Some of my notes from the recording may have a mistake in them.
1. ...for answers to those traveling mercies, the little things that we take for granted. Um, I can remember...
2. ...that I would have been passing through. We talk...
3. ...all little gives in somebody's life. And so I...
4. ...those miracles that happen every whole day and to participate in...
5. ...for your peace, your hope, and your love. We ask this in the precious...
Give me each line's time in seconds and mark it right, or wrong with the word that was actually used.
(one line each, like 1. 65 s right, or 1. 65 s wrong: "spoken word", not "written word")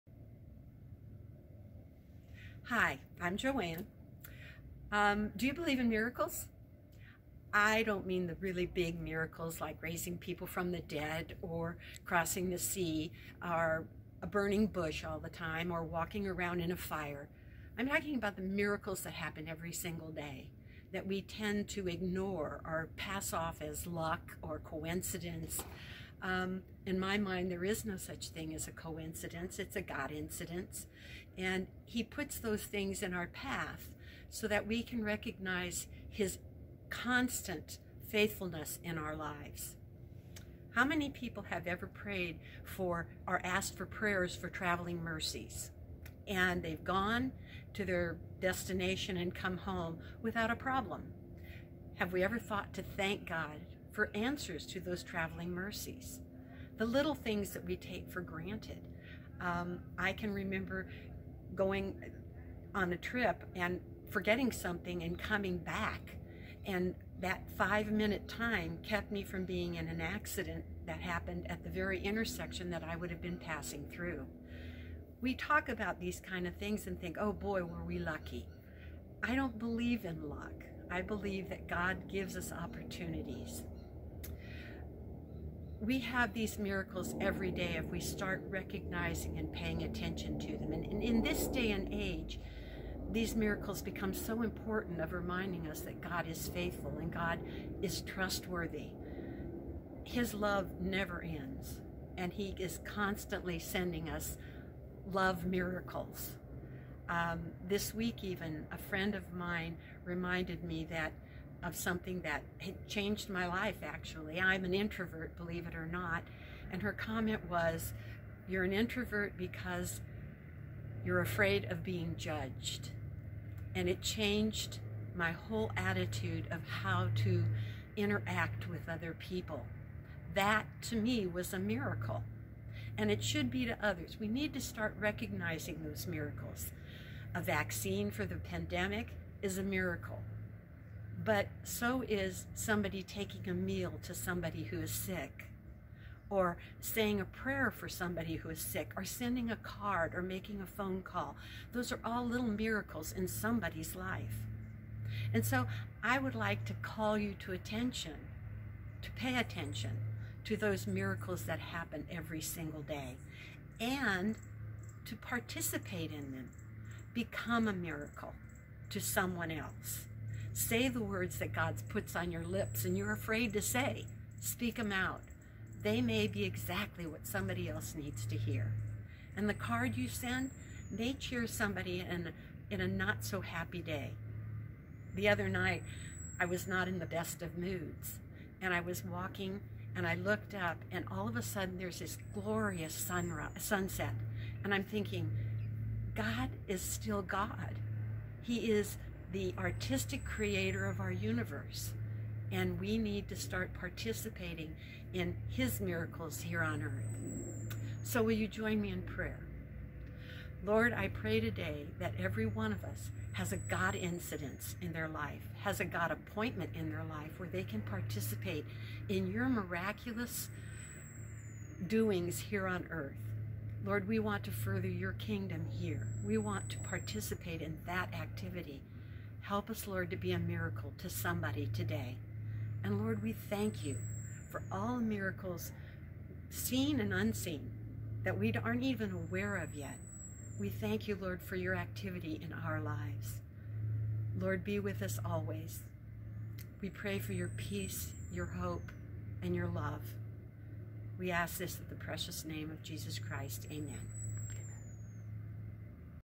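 1. 53 s right
2. 72 s right
3. 152 s wrong: "miracles", not "gives"
4. 160 s wrong: "single", not "whole"
5. 247 s right.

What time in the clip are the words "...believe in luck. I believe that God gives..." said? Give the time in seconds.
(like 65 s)
79 s.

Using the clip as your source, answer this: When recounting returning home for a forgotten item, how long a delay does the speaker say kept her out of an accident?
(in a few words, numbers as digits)
5 minutes.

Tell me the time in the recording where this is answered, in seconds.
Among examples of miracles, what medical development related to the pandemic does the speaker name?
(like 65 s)
137 s.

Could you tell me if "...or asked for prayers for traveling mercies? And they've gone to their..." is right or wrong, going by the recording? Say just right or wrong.
right.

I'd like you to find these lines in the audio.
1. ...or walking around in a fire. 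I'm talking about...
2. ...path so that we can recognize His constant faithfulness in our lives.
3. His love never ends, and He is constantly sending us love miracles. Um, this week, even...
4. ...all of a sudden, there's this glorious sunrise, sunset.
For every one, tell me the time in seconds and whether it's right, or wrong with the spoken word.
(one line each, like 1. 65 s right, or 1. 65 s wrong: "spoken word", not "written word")
1. 15 s right
2. 33 s right
3. 100 s right
4. 191 s right.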